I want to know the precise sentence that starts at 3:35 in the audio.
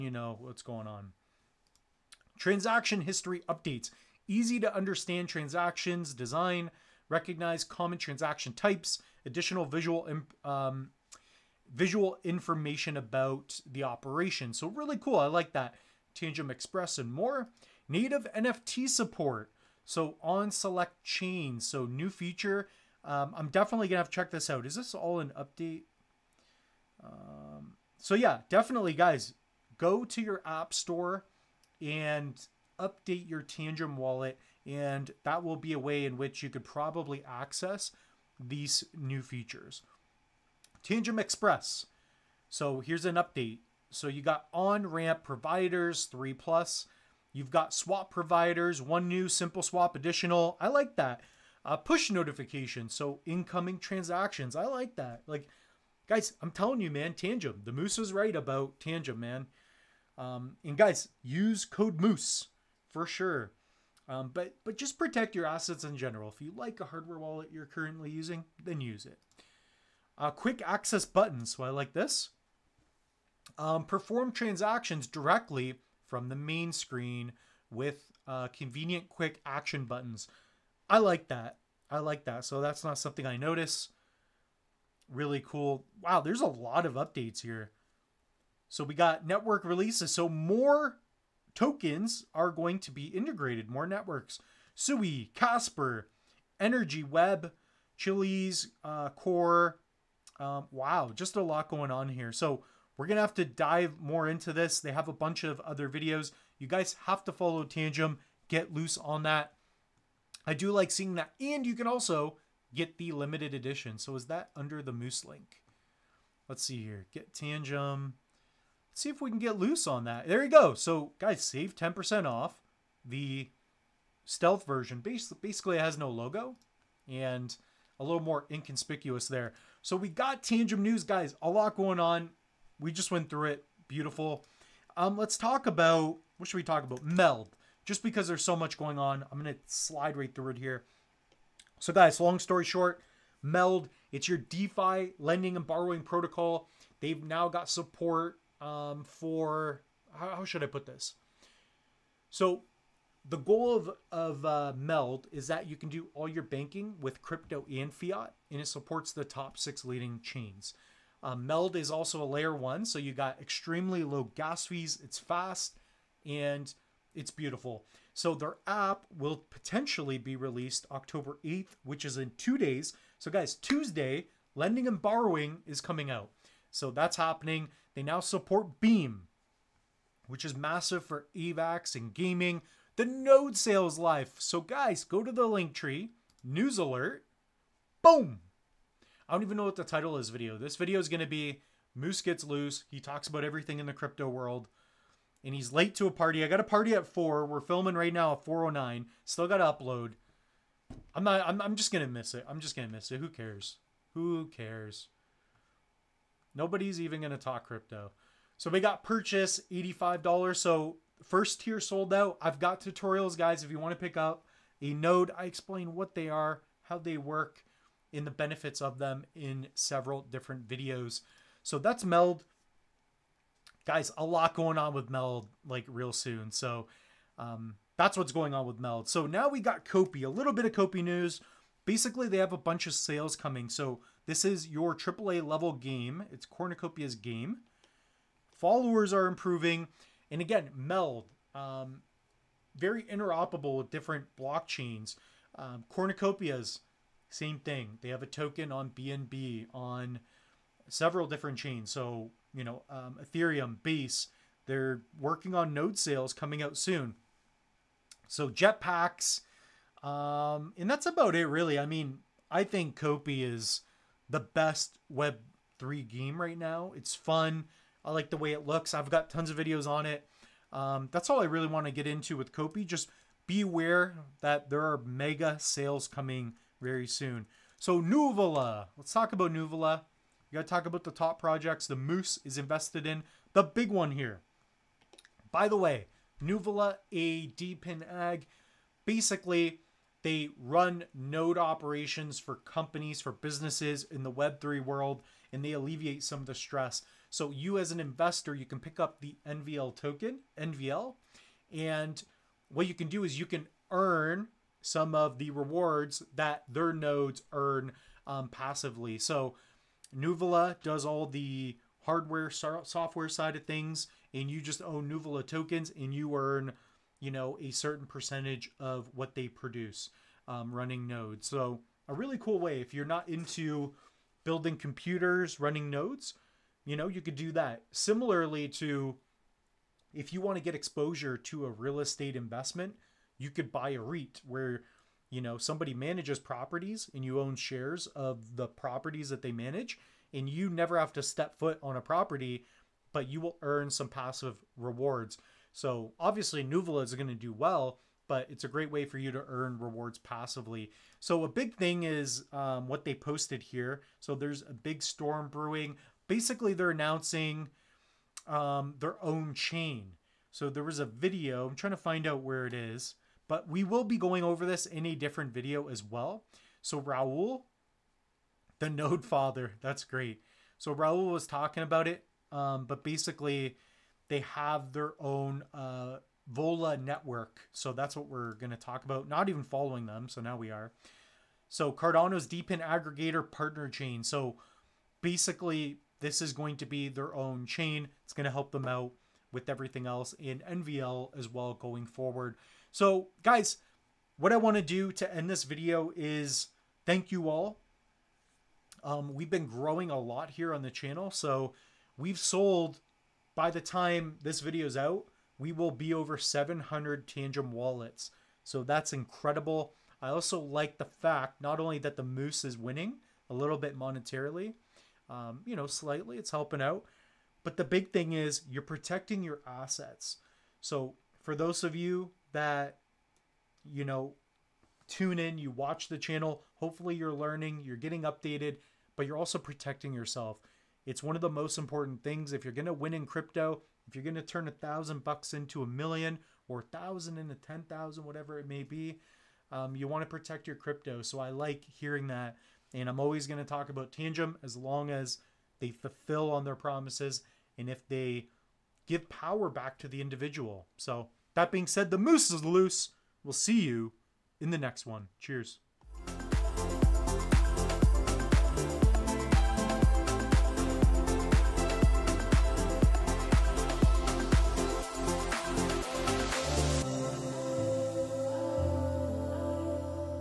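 I explain what they are, how they work, in the benefits of them in several different videos.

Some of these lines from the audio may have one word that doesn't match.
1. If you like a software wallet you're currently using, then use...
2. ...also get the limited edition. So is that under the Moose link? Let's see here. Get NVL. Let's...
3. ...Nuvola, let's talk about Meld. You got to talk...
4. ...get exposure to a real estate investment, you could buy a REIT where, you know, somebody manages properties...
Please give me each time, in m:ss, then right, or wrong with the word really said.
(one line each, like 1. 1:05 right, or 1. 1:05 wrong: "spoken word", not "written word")
1. 1:06 wrong: "hardware", not "software"
2. 1:51 wrong: "Tangem", not "NVL"
3. 4:38 wrong: "Nuvola", not "Meld"
4. 5:30 right.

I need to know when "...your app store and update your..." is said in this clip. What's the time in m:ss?
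0:30.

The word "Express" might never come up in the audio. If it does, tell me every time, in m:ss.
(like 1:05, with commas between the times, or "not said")
0:16, 0:41.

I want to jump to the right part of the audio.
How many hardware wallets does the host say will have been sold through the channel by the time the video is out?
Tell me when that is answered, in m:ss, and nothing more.
6:46.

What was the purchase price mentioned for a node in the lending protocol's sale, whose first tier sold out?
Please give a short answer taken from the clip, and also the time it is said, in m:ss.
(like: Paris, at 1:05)
$85, at 3:29.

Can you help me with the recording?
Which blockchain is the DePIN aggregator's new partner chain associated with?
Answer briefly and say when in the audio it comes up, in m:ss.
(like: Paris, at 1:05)
Cardano, at 6:21.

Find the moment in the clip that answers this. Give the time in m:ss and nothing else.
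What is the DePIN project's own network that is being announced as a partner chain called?
6:16.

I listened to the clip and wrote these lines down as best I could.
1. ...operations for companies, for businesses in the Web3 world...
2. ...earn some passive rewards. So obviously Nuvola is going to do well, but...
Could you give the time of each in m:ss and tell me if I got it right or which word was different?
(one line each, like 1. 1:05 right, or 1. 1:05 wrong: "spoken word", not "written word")
1. 4:51 right
2. 5:43 right.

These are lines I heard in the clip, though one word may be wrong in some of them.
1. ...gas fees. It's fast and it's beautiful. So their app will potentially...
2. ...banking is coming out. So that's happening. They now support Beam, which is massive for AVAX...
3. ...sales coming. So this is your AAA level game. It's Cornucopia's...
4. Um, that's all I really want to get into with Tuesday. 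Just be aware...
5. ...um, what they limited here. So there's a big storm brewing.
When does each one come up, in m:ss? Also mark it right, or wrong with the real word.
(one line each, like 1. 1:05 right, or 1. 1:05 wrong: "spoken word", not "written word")
1. 2:44 right
2. 2:54 wrong: "borrowing", not "banking"
3. 3:52 right
4. 4:30 wrong: "Kopi", not "Tuesday"
5. 5:52 wrong: "posted", not "limited".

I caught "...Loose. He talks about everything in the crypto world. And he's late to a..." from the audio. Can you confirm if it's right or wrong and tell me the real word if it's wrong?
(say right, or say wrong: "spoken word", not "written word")
right.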